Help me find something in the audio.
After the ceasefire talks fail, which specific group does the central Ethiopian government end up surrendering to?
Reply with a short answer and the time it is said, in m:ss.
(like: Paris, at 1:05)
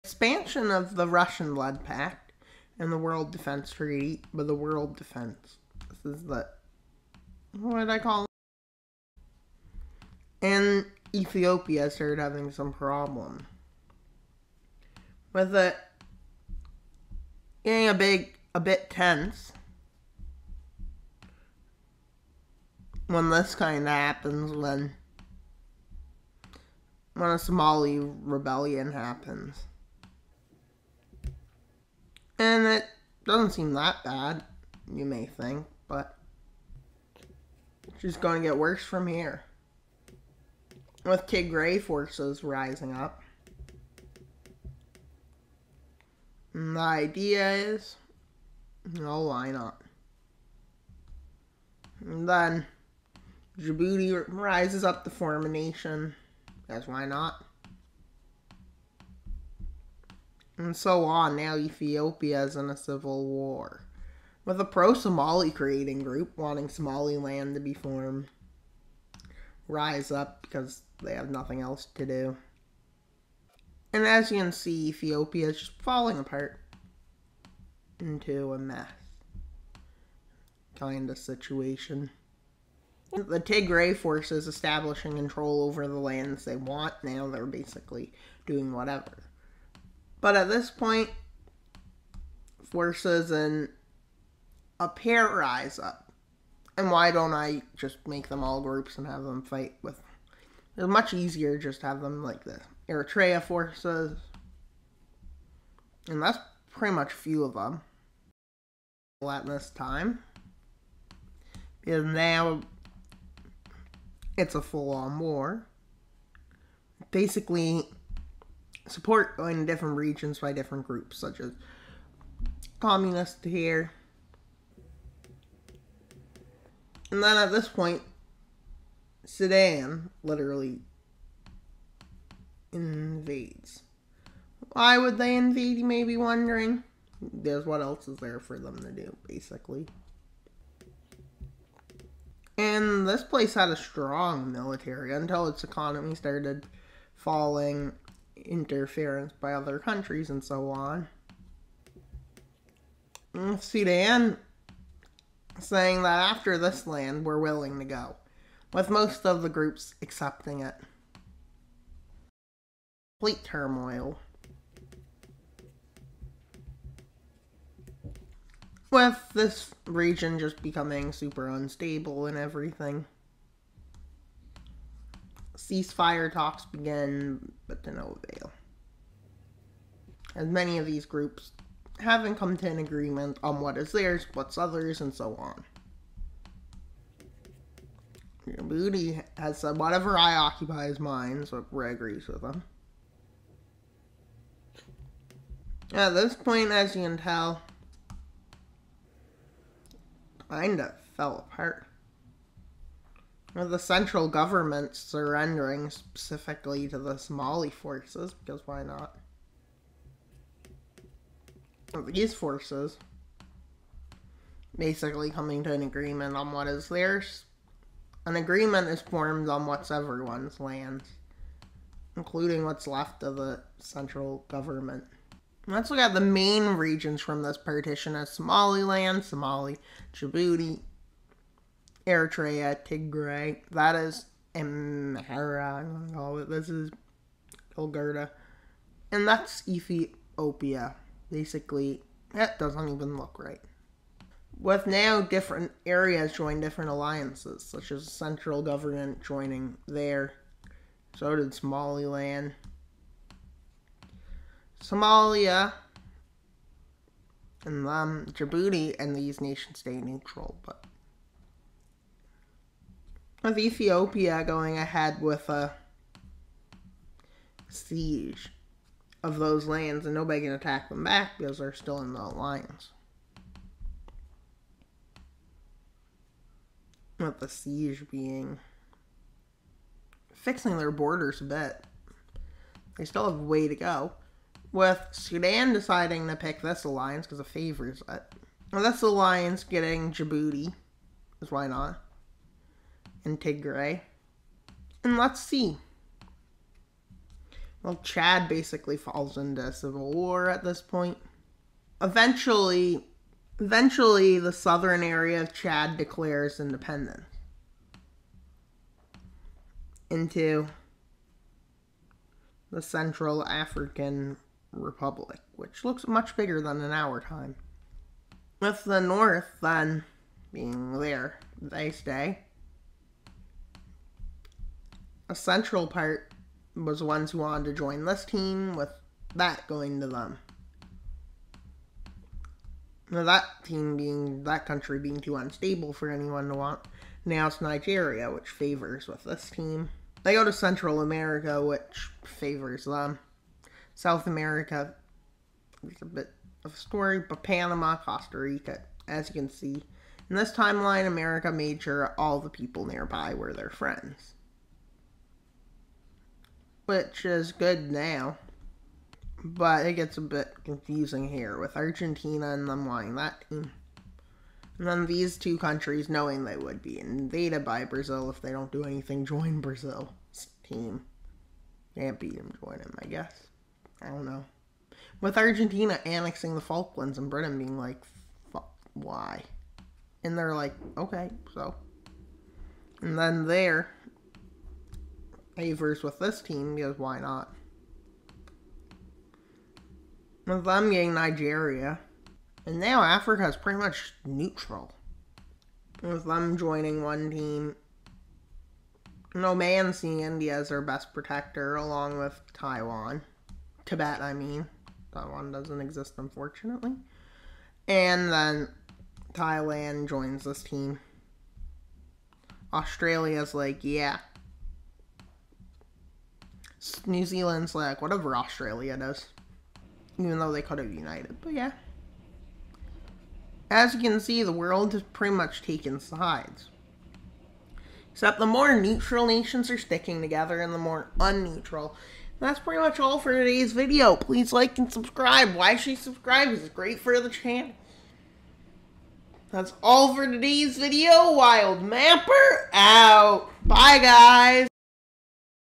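Somali forces, at 3:27.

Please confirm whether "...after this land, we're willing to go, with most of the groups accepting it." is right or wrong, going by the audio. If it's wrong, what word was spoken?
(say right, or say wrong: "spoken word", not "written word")
right.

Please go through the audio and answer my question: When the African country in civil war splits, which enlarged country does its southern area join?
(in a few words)
Central African Republic.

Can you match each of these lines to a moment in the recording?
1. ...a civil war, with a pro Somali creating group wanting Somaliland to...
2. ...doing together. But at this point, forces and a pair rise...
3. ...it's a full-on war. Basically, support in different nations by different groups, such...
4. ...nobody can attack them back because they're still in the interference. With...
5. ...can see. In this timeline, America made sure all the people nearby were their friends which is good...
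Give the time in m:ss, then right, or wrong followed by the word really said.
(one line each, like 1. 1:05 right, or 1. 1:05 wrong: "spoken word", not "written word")
1. 1:02 right
2. 1:28 wrong: "whatever", not "together"
3. 1:54 wrong: "regions", not "nations"
4. 4:30 wrong: "alliance", not "interference"
5. 5:49 right.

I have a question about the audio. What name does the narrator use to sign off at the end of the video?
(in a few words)
Wild Mapper.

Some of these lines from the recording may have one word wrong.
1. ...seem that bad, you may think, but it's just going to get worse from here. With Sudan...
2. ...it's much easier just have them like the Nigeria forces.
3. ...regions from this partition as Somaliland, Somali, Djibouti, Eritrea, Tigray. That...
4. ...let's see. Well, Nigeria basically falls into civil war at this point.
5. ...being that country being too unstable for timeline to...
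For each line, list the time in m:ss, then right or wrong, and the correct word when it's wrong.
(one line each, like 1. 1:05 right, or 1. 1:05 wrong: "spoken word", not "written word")
1. 0:33 wrong: "Tigray", not "Sudan"
2. 1:40 wrong: "Eritrea", not "Nigeria"
3. 3:46 right
4. 4:55 wrong: "Chad", not "Nigeria"
5. 5:33 wrong: "anyone", not "timeline".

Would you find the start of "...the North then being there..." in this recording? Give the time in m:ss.
5:18.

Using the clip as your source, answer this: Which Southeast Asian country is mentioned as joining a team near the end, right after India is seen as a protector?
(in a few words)
Thailand.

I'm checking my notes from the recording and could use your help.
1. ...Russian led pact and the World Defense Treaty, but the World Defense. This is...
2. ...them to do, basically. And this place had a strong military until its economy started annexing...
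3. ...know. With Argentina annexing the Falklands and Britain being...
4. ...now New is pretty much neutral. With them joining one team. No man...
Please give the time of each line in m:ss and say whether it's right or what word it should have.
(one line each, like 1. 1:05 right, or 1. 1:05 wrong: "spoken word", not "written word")
1. 0:01 right
2. 2:18 wrong: "falling", not "annexing"
3. 6:14 right
4. 6:32 wrong: "Africa", not "New".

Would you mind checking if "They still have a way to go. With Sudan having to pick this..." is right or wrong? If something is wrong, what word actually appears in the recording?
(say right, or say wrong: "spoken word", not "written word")
wrong: "deciding", not "having".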